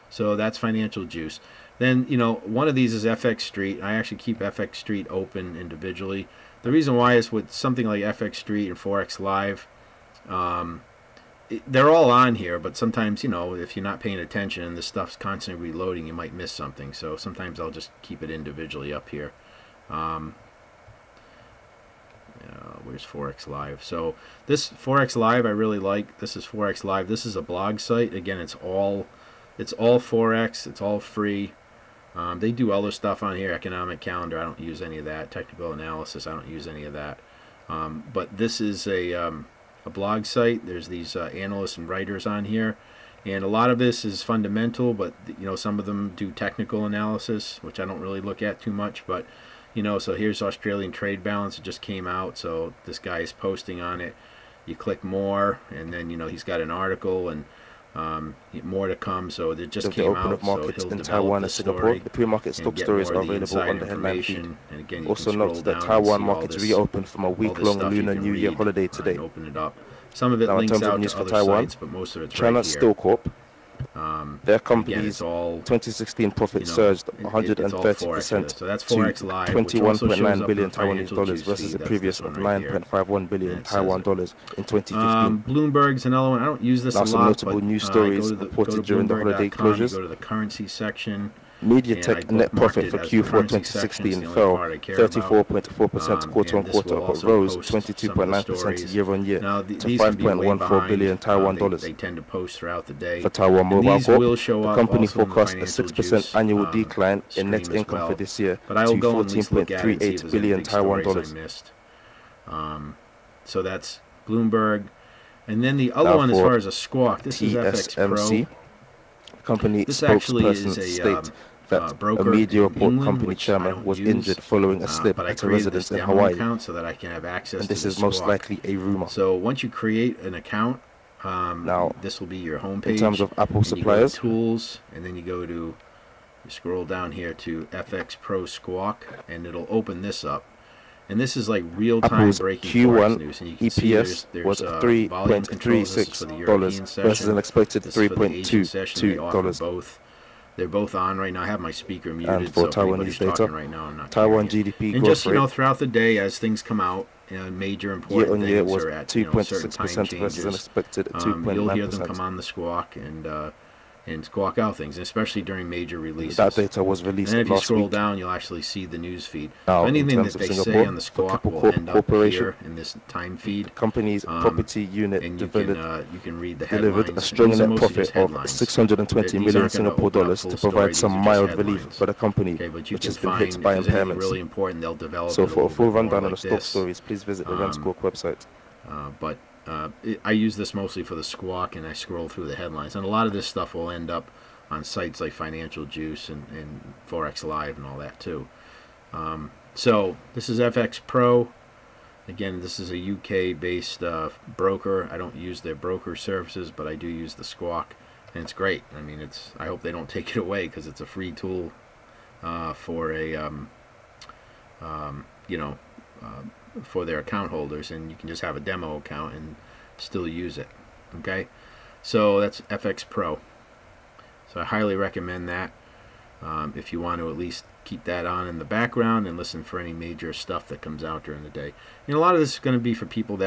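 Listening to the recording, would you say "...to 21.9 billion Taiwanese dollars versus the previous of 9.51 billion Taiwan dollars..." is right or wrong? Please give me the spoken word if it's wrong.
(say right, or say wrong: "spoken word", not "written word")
right.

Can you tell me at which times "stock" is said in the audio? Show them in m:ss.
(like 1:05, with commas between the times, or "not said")
1:02, 3:06.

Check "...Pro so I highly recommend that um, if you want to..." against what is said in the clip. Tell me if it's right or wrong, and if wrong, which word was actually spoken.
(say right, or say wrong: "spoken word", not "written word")
right.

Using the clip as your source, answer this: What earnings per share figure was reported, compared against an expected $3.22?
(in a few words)
$3.36.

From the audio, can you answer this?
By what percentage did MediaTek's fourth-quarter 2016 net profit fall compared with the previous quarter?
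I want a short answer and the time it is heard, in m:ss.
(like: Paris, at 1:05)
34.4%, at 1:34.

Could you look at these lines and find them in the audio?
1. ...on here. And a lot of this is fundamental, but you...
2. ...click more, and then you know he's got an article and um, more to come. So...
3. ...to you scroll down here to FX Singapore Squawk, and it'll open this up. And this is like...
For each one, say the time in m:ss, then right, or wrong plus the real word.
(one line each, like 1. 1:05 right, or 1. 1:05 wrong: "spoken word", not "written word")
1. 0:42 right
2. 0:54 right
3. 2:15 wrong: "Pro", not "Singapore".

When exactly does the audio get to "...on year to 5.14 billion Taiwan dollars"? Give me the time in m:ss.
1:39.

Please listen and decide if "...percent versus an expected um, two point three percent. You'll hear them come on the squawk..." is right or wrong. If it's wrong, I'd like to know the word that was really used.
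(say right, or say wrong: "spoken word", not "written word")
wrong: "nine", not "three".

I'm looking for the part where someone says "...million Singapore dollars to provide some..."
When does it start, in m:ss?
2:59.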